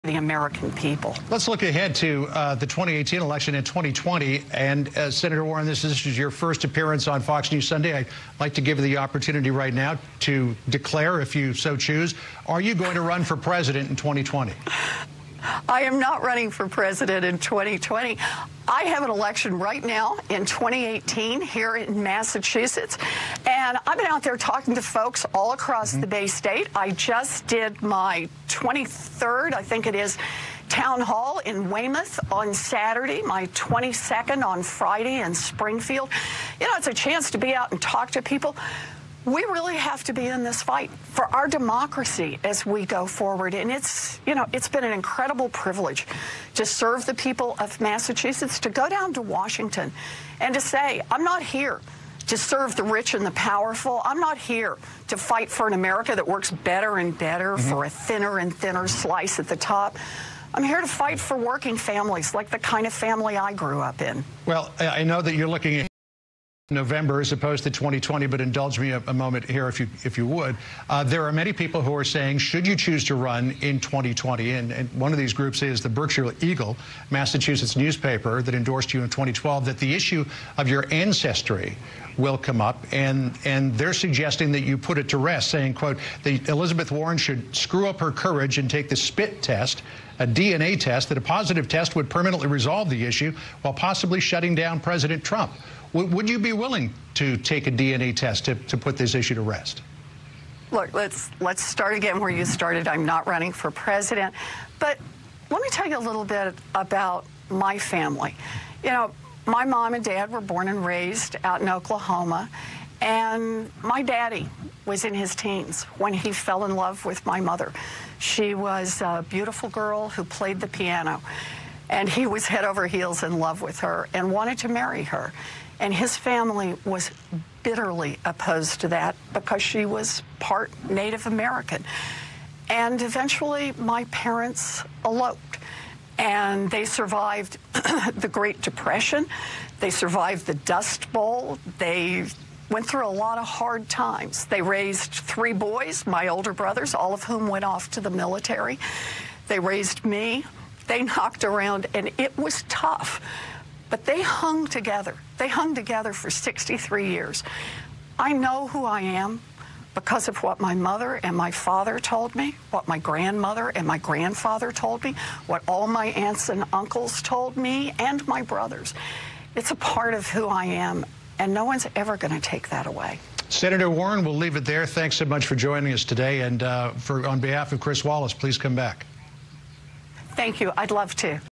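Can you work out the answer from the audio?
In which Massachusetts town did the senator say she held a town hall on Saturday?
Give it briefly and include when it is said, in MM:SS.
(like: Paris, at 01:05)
Weymouth, at 00:31.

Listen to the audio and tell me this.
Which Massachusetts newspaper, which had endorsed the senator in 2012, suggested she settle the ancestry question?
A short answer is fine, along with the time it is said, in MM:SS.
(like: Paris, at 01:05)
Berkshire Eagle, at 01:15.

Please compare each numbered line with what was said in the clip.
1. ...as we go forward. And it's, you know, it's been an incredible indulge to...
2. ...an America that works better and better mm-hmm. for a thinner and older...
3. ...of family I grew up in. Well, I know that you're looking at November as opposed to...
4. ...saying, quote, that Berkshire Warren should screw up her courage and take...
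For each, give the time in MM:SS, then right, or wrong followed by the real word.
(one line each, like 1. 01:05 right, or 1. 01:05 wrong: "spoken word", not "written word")
1. 00:42 wrong: "privilege", not "indulge"
2. 00:55 wrong: "thinner", not "older"
3. 01:02 right
4. 01:25 wrong: "Elizabeth", not "Berkshire".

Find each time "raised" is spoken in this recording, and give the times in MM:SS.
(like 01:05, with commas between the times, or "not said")
01:50, 02:24, 02:29.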